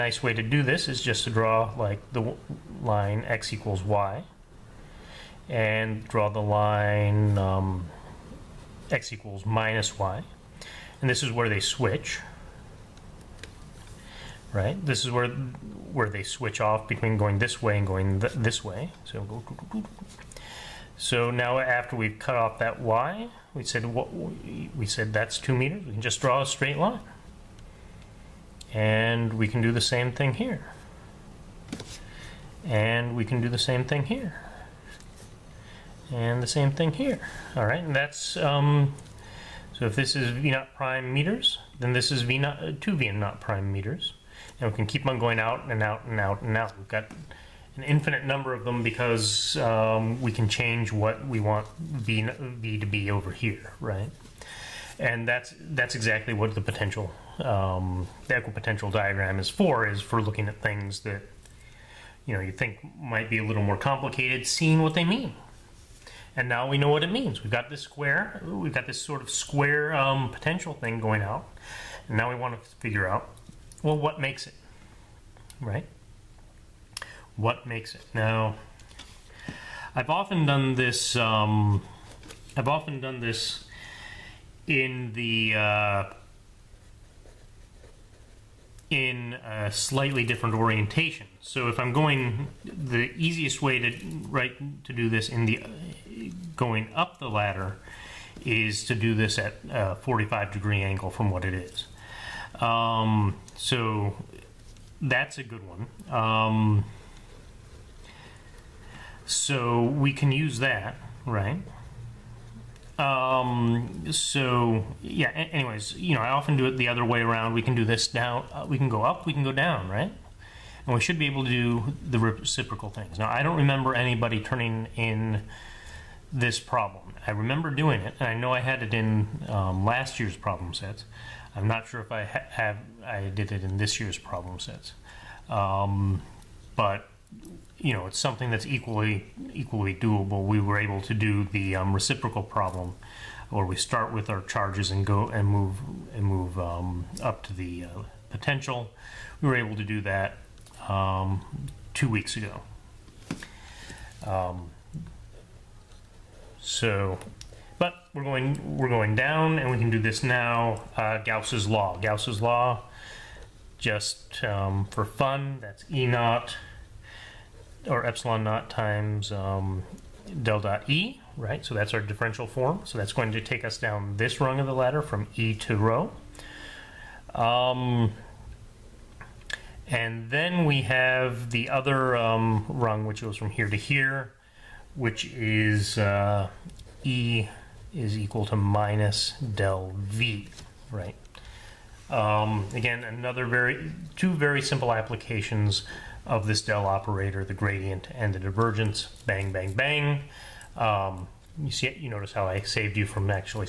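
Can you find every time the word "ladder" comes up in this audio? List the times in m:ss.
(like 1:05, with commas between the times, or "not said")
1:37, 2:54.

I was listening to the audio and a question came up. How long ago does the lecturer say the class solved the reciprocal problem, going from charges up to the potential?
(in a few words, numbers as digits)
Two weeks ago.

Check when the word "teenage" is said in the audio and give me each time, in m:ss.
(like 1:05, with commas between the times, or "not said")
not said.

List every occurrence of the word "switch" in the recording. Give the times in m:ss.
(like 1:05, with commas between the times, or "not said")
0:11, 0:16.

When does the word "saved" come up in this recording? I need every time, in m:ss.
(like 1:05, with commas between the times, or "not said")
3:22.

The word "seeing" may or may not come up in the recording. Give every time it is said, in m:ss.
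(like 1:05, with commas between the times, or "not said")
1:04.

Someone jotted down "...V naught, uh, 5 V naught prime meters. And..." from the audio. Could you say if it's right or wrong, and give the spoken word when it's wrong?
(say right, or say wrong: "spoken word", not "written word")
wrong: "2", not "5".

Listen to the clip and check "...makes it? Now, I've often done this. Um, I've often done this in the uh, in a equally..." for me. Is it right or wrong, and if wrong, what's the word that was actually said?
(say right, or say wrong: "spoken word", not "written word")
wrong: "slightly", not "equally".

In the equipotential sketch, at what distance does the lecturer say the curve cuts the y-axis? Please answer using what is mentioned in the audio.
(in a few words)
2 meters.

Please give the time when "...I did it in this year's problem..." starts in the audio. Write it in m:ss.
2:13.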